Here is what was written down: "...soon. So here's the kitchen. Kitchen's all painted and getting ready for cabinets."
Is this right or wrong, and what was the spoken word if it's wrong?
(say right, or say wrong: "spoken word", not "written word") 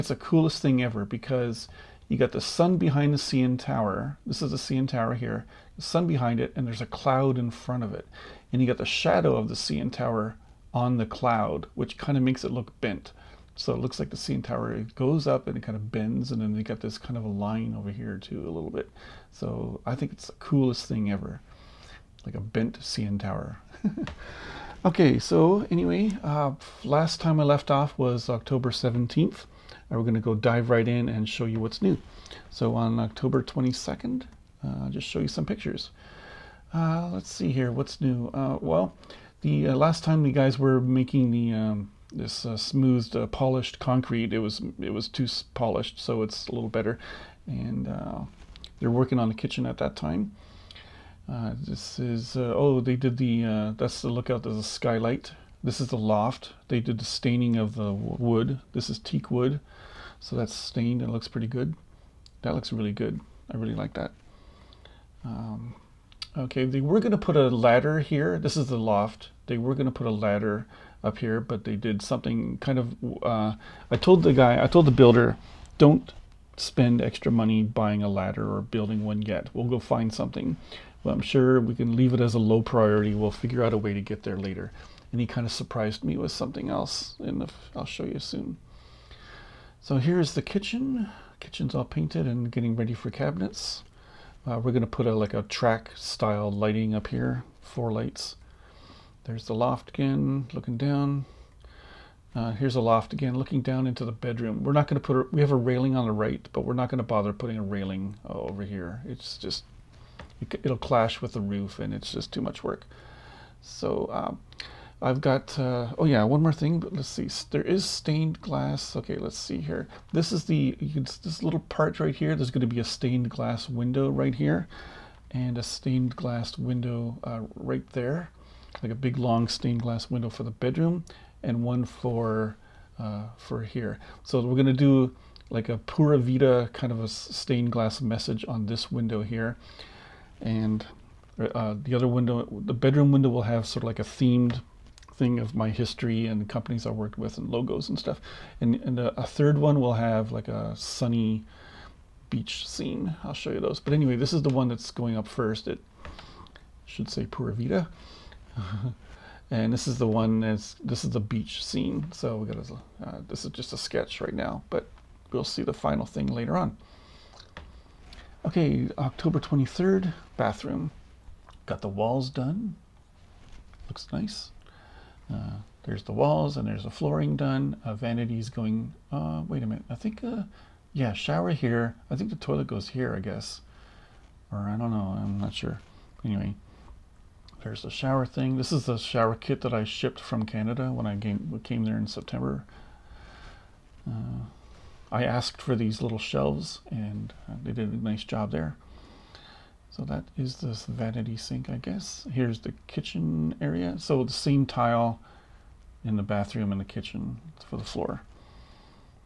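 right.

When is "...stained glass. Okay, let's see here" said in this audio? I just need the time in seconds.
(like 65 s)
117 s.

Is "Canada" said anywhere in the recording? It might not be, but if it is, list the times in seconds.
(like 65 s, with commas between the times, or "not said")
190 s.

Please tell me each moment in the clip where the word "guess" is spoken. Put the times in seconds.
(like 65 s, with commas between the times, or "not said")
183 s, 201 s.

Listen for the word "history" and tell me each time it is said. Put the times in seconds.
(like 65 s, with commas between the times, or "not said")
145 s.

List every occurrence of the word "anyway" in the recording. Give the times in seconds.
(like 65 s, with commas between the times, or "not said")
25 s, 153 s, 186 s.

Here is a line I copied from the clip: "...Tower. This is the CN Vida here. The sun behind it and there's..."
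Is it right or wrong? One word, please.
wrong.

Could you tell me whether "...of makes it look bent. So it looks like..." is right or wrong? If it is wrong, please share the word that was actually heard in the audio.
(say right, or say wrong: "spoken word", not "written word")
right.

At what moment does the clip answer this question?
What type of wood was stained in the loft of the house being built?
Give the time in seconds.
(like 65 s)
58 s.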